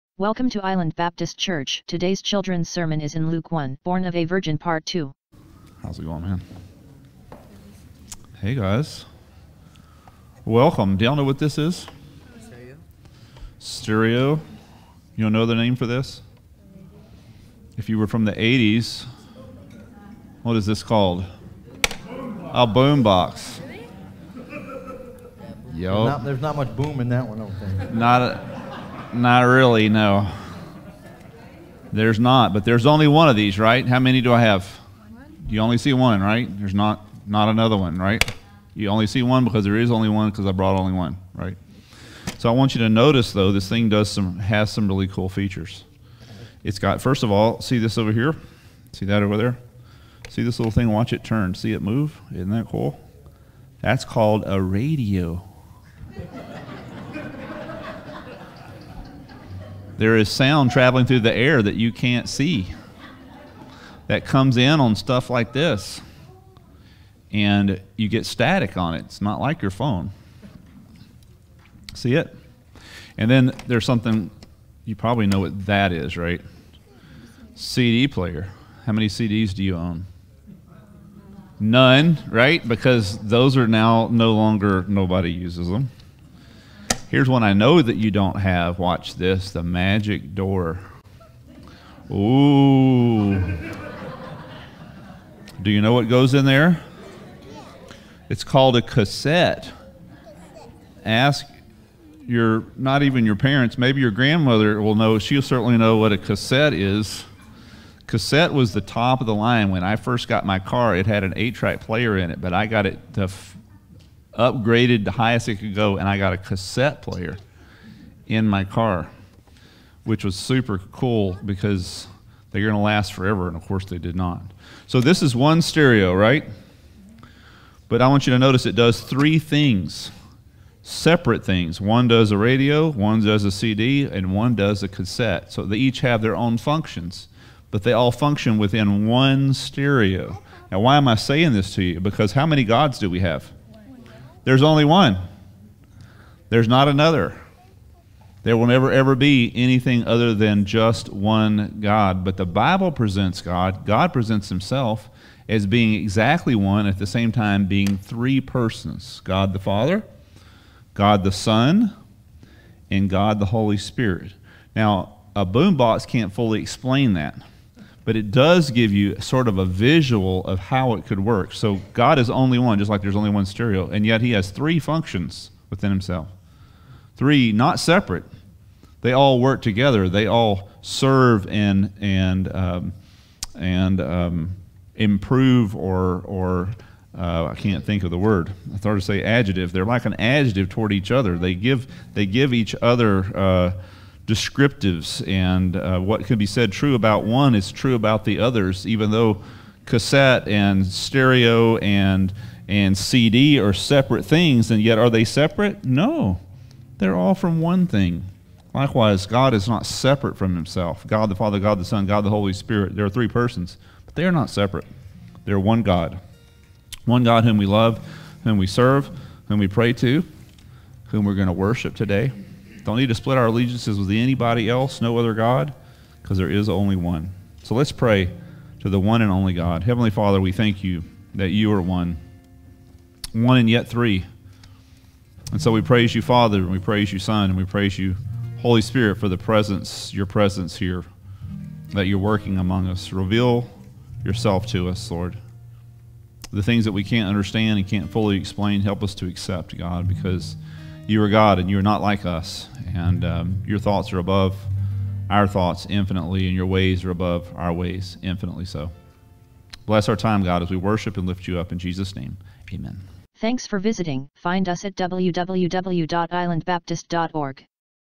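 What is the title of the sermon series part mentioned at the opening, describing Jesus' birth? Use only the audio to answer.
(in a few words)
Born of a Virgin.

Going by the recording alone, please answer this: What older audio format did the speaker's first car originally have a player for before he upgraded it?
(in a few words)
eight track.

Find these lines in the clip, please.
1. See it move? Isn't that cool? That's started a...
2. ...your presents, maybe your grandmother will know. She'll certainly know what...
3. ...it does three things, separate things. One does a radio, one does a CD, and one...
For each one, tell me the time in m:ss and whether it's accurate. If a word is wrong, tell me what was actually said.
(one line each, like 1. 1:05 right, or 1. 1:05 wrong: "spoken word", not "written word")
1. 0:51 wrong: "called", not "started"
2. 1:43 wrong: "parents", not "presents"
3. 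2:08 right.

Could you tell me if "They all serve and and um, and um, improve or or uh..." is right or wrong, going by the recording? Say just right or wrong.
right.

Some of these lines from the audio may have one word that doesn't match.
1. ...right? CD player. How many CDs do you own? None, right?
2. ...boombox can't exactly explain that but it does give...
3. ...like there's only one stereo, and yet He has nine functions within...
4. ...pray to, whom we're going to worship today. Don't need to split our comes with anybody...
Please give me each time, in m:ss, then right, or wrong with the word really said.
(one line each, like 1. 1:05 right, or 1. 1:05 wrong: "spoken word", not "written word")
1. 1:16 right
2. 2:45 wrong: "fully", not "exactly"
3. 2:52 wrong: "three", not "nine"
4. 3:39 wrong: "allegiances", not "comes".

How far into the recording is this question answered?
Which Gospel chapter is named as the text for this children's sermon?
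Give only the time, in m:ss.
0:03.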